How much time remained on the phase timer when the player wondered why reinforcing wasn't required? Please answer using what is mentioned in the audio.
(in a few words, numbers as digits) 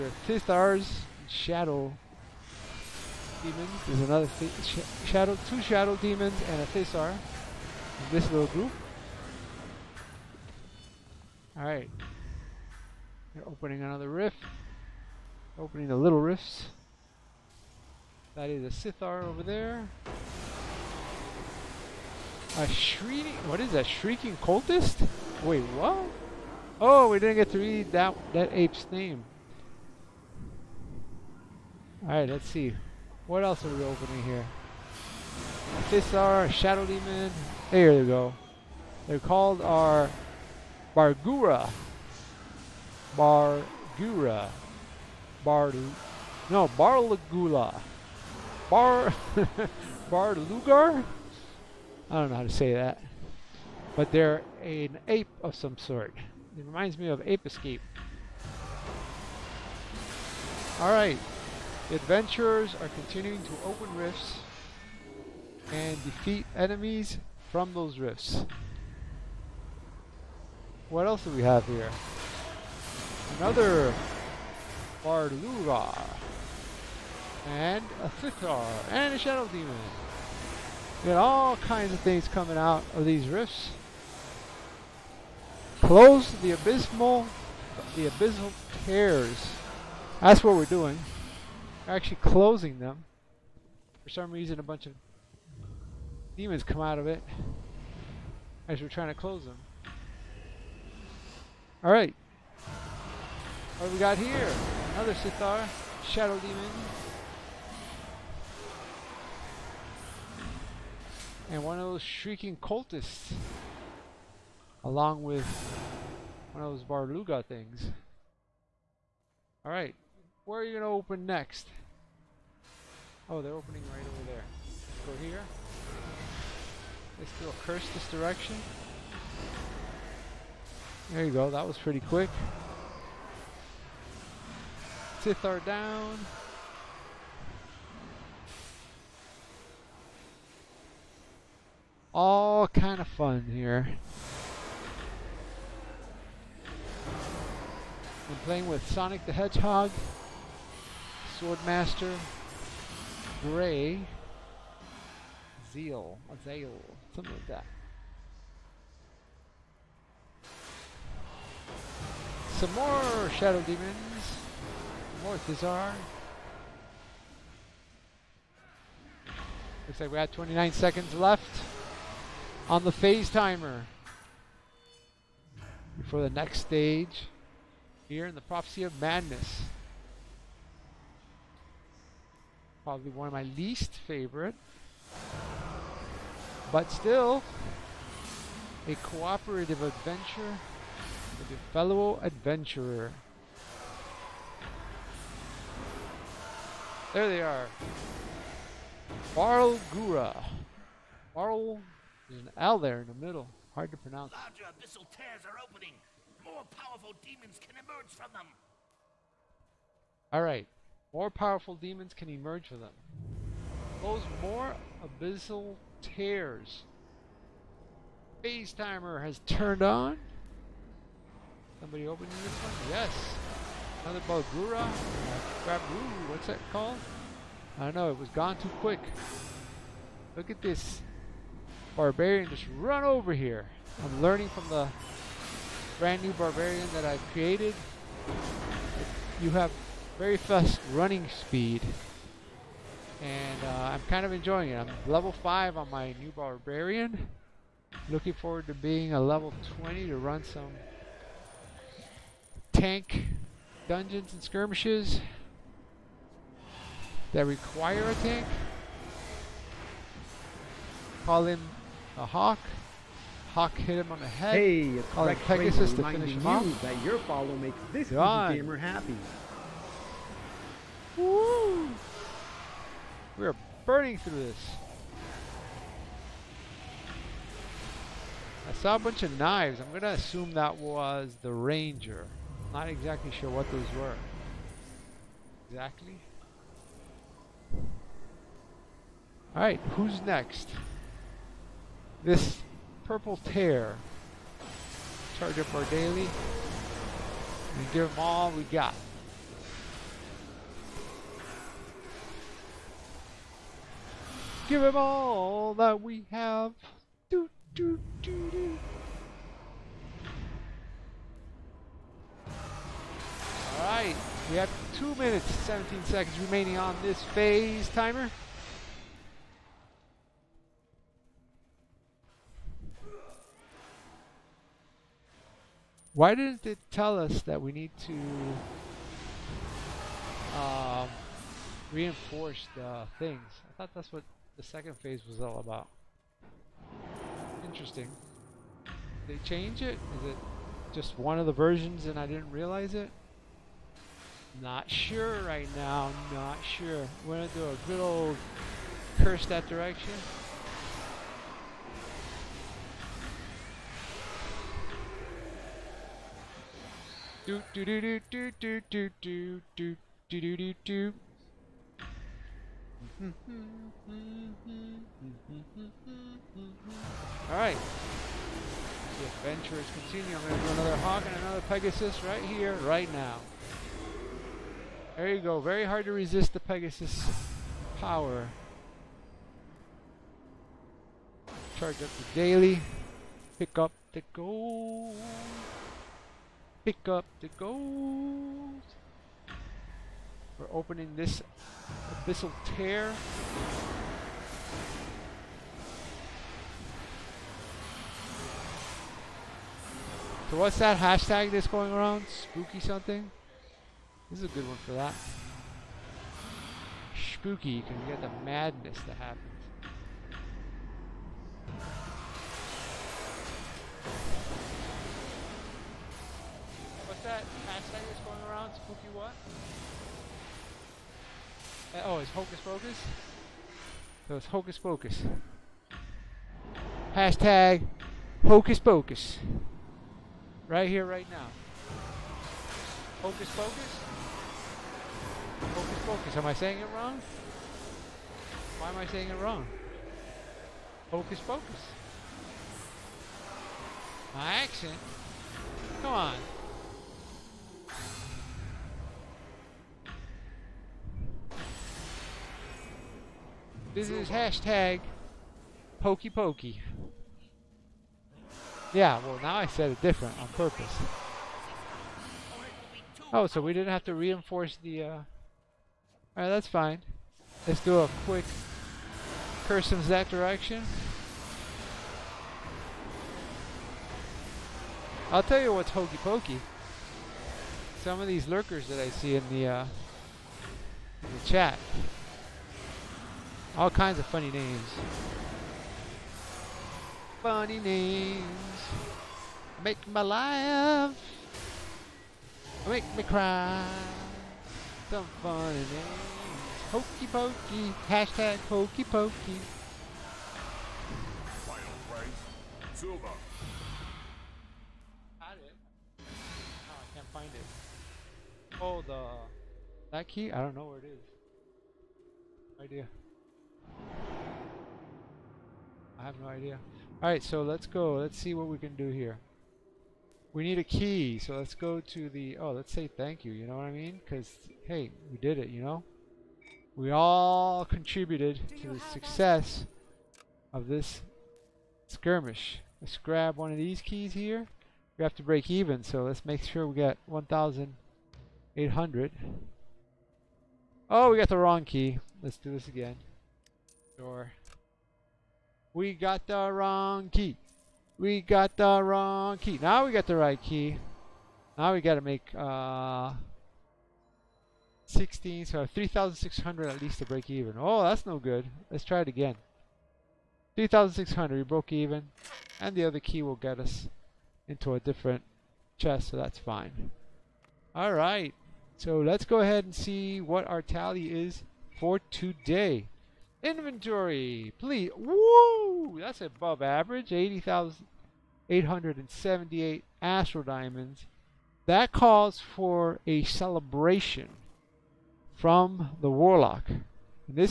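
2 minutes 17 seconds.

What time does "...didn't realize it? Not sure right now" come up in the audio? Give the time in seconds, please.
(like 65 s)
342 s.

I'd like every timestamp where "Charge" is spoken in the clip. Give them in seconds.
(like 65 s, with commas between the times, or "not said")
295 s, 381 s.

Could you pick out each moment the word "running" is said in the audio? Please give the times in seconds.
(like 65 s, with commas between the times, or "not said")
240 s.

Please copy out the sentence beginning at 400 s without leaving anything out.
So what's that hashtag that's going around?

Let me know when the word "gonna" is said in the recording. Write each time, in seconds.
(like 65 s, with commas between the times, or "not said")
279 s.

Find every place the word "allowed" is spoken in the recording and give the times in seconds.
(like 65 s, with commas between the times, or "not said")
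not said.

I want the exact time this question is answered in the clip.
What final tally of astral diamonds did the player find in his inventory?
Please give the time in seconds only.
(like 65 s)
577 s.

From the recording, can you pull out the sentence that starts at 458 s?
Yeah, well now I said it different on purpose.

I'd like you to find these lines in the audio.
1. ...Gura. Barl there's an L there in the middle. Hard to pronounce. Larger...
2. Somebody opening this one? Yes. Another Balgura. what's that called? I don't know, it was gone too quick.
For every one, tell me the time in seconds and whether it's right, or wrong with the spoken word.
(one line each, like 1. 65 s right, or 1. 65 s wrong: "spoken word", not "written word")
1. 199 s right
2. 221 s right.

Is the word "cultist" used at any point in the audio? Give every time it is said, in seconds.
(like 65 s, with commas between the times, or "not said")
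24 s, 112 s.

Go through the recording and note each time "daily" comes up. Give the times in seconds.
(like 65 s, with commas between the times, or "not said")
295 s, 382 s.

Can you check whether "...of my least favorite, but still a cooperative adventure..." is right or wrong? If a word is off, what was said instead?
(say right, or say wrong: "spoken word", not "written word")
right.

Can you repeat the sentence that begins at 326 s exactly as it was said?
Why didn't it tell us that we need to um, reinforce the things?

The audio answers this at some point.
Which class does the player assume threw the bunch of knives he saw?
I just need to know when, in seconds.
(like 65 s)
281 s.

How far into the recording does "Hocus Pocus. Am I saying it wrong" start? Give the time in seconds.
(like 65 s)
435 s.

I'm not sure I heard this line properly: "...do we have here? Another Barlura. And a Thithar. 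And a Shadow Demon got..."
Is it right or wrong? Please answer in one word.
right.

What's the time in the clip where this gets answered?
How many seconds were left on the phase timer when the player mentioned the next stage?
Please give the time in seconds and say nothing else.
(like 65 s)
170 s.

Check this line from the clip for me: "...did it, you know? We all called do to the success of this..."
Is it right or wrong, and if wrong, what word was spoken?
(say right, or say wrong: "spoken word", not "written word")
wrong: "contributed", not "called".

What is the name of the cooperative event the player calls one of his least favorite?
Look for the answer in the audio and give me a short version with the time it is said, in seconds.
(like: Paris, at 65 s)
Prophecy of Madness, at 178 s.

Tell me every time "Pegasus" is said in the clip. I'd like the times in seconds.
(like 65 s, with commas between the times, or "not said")
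265 s, 371 s, 376 s.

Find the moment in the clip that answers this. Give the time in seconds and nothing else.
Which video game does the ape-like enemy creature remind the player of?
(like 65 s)
57 s.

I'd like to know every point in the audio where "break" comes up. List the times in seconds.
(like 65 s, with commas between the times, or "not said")
535 s, 557 s.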